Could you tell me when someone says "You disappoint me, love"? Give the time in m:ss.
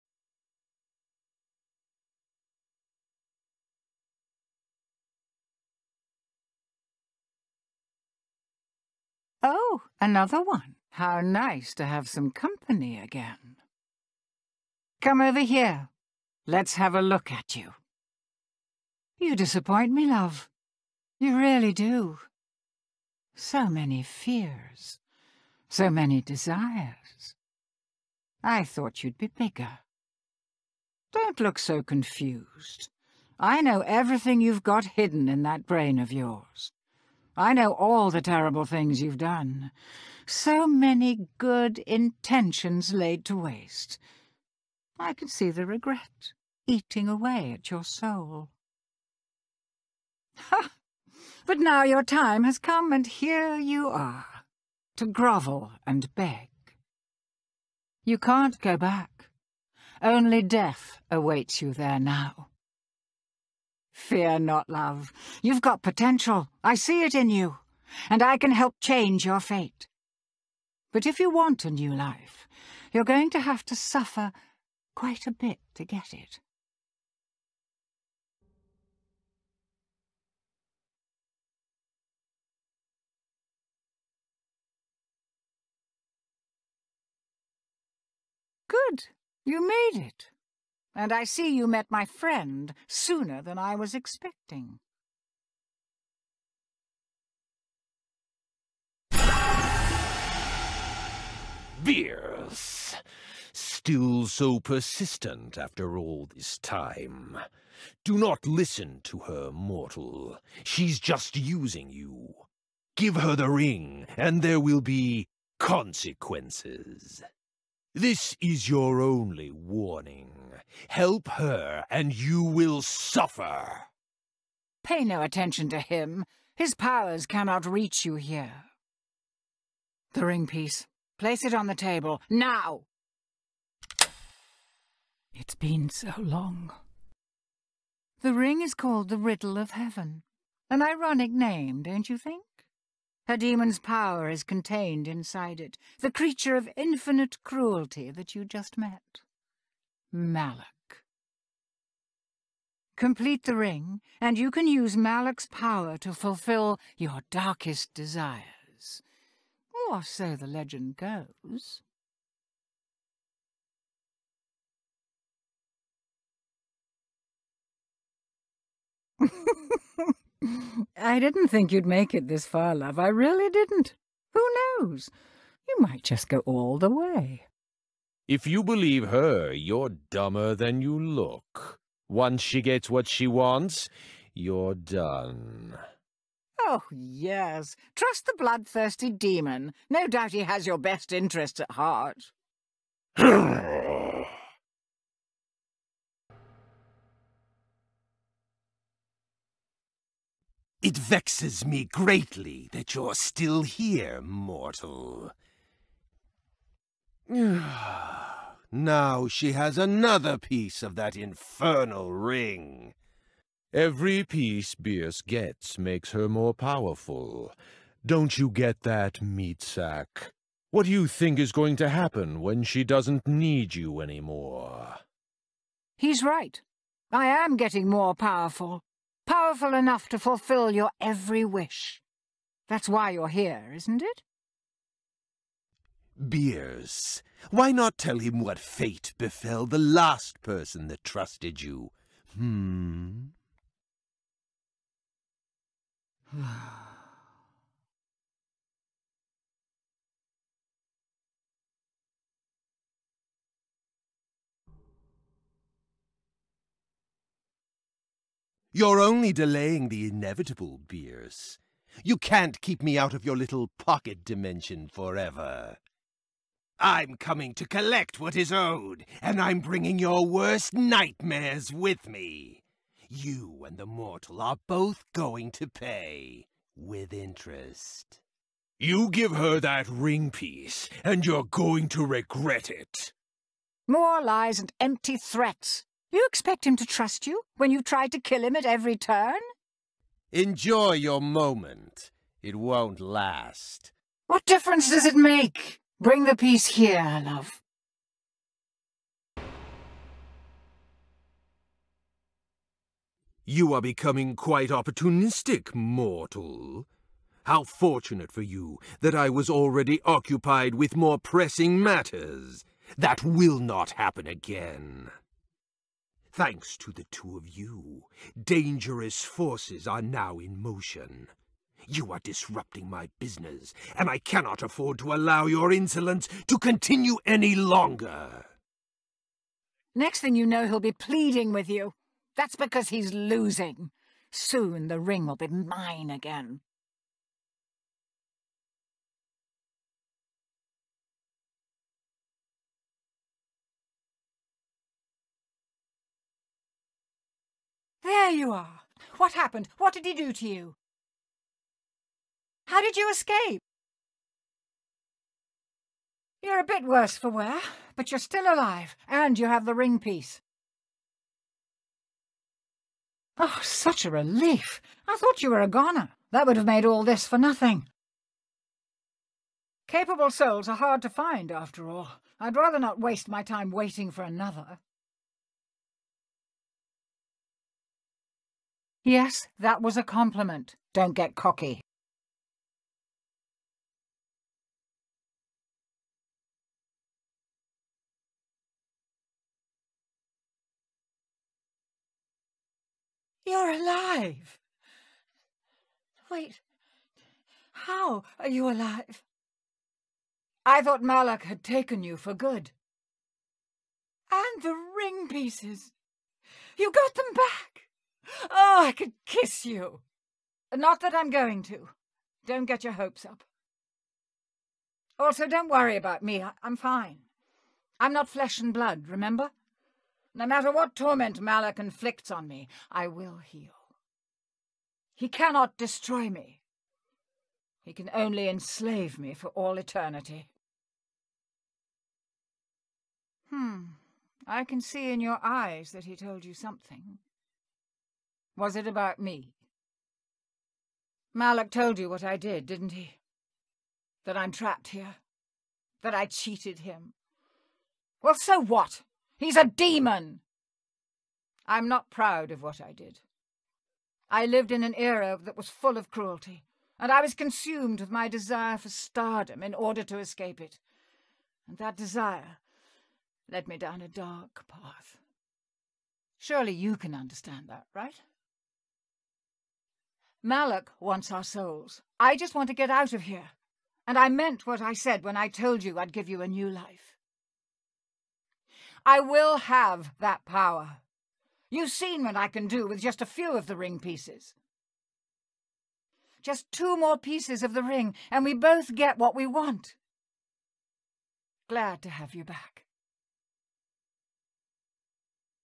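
0:19.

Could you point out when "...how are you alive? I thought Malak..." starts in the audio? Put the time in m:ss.
6:37.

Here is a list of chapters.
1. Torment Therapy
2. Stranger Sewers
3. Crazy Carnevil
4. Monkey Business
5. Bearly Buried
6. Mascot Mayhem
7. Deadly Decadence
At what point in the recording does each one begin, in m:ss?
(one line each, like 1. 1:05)
1. 4:59
2. 3:16
3. 4:14
4. 1:18
5. 6:23
6. 5:38
7. 2:45.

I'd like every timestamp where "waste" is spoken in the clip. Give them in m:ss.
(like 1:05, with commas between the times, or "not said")
0:43, 6:12.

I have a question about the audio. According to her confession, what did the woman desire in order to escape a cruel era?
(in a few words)
stardom.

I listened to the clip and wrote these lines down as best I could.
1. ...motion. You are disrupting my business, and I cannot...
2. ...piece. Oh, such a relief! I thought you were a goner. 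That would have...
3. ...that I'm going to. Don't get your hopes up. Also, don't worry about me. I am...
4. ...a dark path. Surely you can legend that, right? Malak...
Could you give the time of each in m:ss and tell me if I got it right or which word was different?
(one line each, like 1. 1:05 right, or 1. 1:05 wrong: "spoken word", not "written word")
1. 5:20 right
2. 5:59 right
3. 6:51 right
4. 7:44 wrong: "understand", not "legend".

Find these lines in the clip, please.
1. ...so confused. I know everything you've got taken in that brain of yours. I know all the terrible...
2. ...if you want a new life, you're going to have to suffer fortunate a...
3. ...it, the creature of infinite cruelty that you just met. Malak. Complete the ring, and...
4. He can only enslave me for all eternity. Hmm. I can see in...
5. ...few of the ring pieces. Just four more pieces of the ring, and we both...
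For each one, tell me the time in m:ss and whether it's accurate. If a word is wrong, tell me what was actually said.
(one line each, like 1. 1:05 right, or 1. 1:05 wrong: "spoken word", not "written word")
1. 0:31 wrong: "hidden", not "taken"
2. 1:11 wrong: "quite", not "fortunate"
3. 2:25 right
4. 7:07 right
5. 8:03 wrong: "two", not "four".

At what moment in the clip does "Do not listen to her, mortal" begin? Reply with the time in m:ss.
1:48.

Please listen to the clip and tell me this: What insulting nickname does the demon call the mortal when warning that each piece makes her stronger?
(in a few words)
meat sack.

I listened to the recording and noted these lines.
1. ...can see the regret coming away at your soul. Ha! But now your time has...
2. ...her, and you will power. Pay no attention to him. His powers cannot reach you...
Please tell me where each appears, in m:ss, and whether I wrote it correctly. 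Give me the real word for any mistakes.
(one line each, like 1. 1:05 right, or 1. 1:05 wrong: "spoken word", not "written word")
1. 0:45 wrong: "eating", not "coming"
2. 2:01 wrong: "suffer", not "power".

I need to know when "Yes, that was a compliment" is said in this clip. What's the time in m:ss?
6:19.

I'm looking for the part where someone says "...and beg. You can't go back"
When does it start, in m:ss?
0:55.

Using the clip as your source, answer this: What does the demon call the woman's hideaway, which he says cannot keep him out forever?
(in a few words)
pocket dimension.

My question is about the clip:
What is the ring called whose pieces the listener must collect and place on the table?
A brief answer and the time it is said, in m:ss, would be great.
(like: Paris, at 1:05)
Riddle of Heaven, at 2:19.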